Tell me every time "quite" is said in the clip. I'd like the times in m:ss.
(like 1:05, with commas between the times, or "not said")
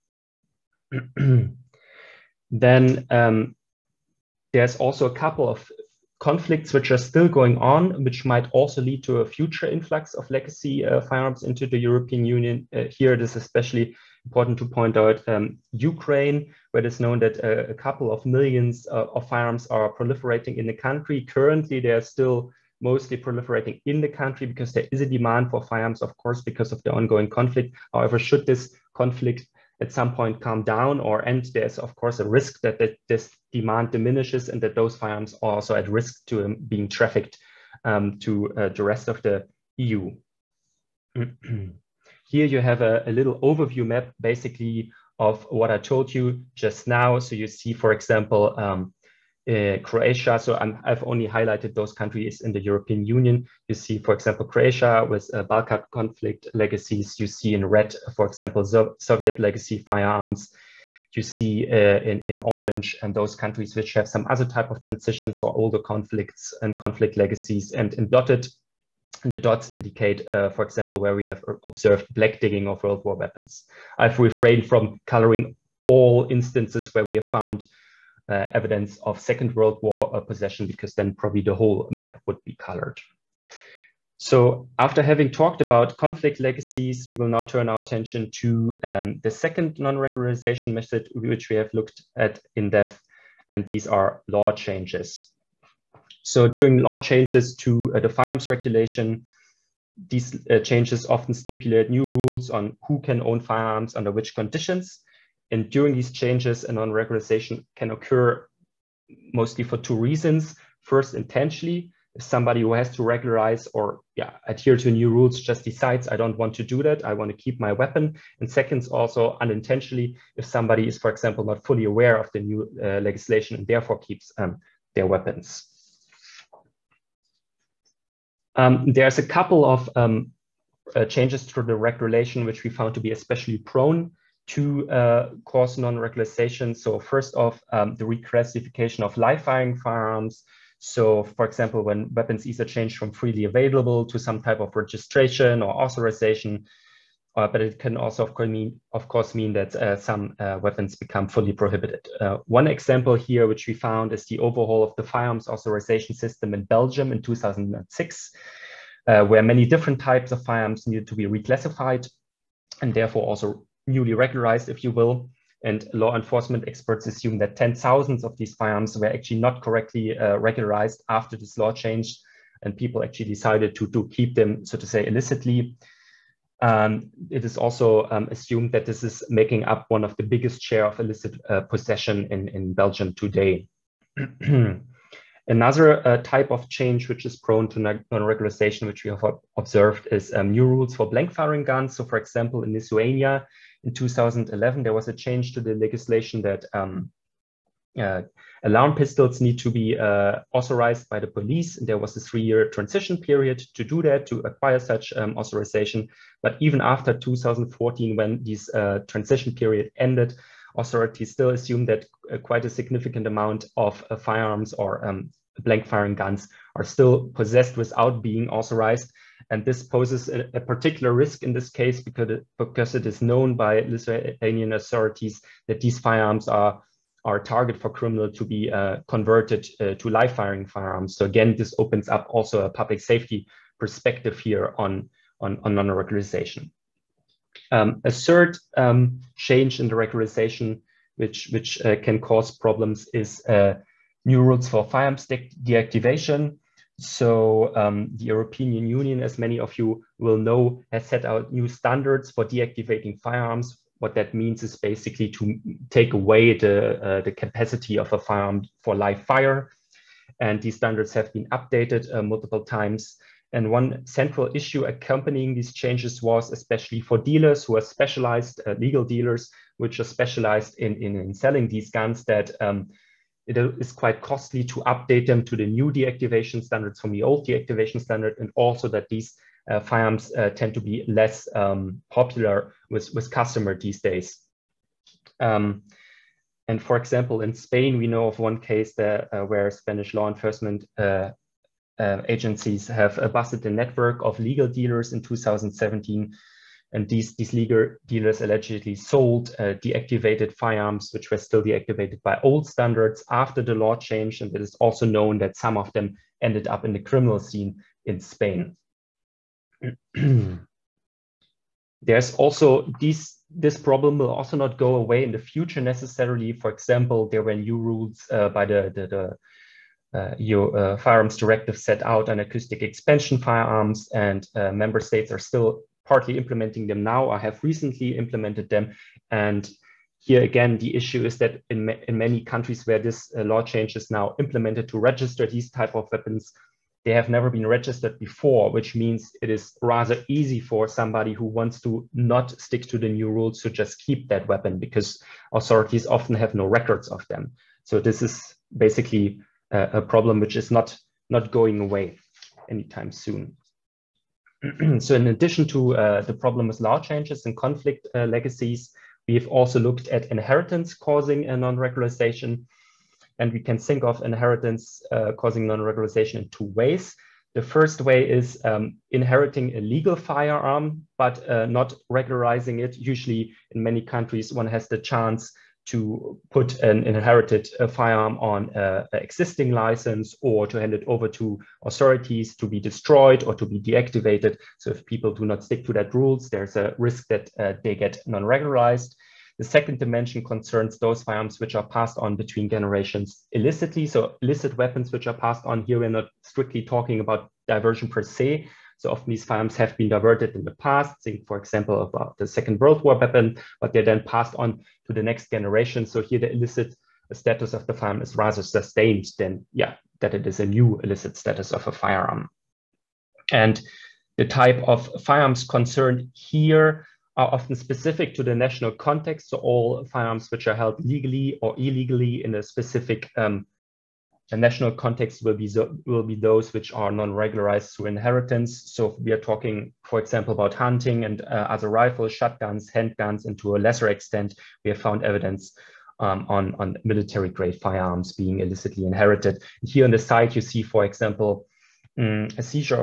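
3:32, 4:33.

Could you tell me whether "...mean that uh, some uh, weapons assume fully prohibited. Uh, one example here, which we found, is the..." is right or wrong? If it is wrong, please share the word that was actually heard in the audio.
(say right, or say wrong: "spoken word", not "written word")
wrong: "become", not "assume".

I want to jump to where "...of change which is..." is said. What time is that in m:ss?
3:06.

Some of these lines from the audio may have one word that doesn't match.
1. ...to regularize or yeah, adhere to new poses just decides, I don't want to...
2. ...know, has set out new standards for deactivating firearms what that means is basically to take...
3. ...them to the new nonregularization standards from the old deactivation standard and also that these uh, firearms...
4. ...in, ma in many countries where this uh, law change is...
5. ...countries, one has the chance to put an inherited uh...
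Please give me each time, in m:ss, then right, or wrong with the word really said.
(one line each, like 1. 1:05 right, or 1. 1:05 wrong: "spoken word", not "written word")
1. 1:52 wrong: "rules", not "poses"
2. 4:10 right
3. 4:35 wrong: "deactivation", not "nonregularization"
4. 5:31 right
5. 6:14 right.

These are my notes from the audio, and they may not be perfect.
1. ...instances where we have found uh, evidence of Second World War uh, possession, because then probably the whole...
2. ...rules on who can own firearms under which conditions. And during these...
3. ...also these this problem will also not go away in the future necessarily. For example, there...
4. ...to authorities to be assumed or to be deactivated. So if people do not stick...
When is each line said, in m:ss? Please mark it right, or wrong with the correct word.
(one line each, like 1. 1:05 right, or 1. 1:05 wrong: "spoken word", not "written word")
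1. 1:16 right
2. 1:42 right
3. 5:12 right
4. 6:21 wrong: "destroyed", not "assumed".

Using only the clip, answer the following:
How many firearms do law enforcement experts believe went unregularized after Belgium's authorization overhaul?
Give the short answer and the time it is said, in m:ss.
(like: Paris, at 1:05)
10,000, at 2:47.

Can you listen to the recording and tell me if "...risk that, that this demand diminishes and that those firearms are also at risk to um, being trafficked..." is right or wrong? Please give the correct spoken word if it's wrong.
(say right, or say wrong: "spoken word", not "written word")
right.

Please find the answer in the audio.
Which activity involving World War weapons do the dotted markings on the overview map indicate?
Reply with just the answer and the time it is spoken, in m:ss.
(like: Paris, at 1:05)
Black digging, at 1:12.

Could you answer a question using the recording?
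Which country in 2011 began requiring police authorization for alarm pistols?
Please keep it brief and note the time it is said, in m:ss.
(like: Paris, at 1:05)
Lithuania, at 3:12.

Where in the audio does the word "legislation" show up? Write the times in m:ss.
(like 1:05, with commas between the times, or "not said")
2:02, 3:15.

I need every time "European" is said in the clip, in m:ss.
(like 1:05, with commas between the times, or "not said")
0:11, 0:52, 4:08.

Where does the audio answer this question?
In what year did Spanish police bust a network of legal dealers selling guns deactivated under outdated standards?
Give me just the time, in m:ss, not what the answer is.
4:55.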